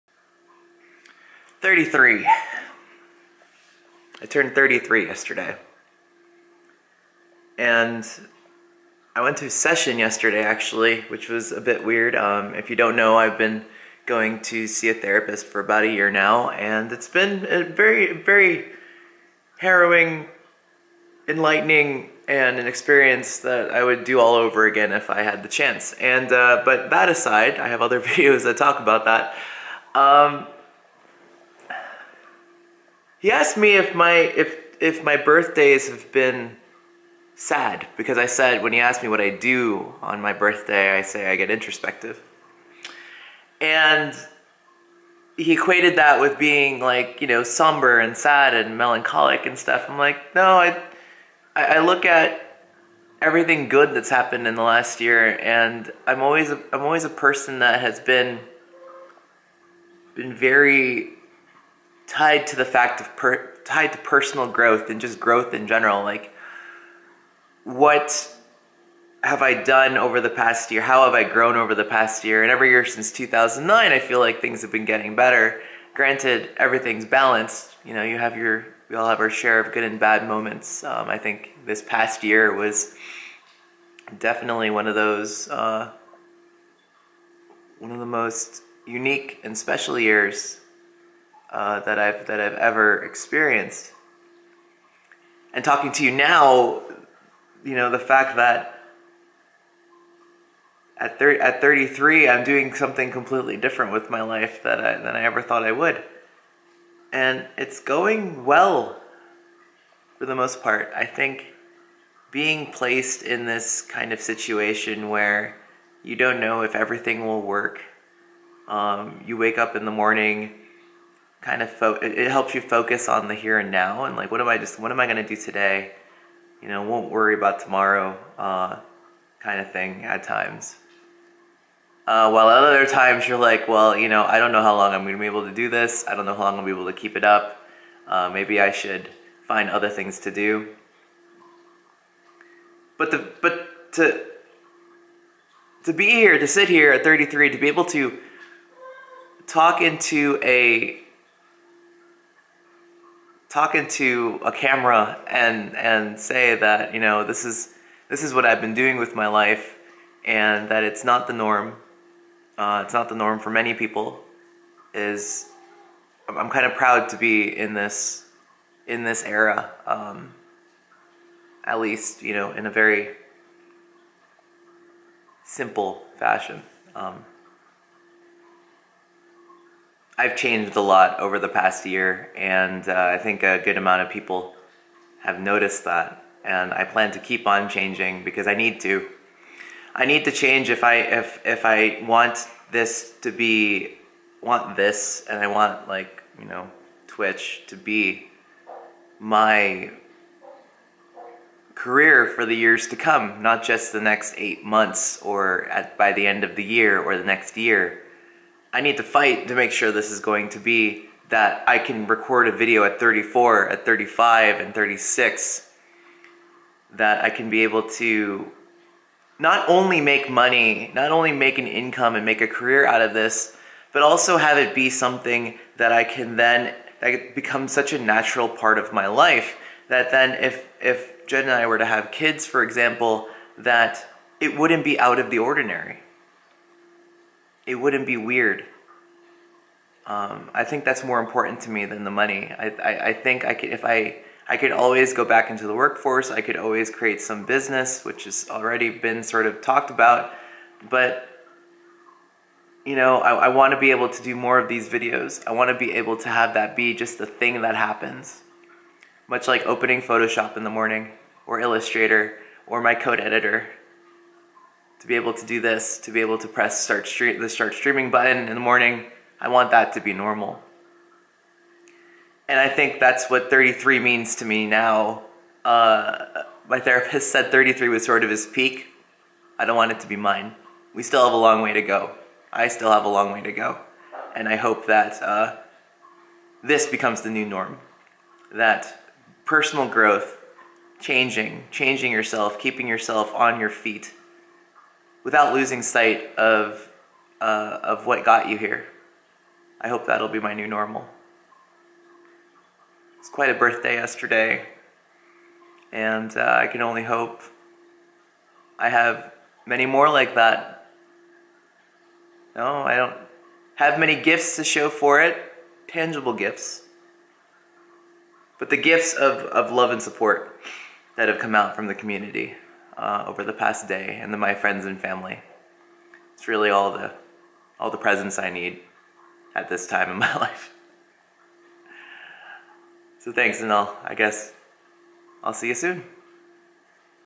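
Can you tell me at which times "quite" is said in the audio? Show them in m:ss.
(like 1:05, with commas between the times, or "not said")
5:03.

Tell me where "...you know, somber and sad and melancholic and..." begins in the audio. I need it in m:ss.
0:47.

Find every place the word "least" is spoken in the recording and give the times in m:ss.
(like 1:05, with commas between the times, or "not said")
2:51.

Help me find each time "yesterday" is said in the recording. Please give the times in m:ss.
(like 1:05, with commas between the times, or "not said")
0:05, 0:09, 5:03.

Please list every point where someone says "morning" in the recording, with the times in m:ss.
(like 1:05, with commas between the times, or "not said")
1:59, 4:20, 4:28.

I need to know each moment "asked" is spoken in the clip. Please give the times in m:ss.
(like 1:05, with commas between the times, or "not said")
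0:33, 0:38.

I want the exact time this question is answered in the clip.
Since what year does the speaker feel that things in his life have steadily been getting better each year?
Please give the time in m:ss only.
1:13.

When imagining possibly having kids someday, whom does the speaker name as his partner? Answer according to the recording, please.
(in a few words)
Jen.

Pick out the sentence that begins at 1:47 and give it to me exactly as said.
And it's going well for the most part.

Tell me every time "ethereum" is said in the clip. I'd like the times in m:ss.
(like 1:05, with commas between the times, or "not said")
not said.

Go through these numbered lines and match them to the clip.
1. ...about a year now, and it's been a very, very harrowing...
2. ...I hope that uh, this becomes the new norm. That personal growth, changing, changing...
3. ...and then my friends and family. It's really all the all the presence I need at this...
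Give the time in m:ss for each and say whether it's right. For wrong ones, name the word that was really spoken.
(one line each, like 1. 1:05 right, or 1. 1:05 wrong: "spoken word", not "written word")
1. 0:15 right
2. 4:44 right
3. 5:24 right.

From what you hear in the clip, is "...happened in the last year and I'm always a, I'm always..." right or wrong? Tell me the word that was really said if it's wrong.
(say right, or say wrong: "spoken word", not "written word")
right.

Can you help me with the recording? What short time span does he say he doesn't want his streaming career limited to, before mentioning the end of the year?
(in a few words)
8 months.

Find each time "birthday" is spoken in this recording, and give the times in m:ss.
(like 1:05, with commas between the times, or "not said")
0:35, 0:40, 5:03.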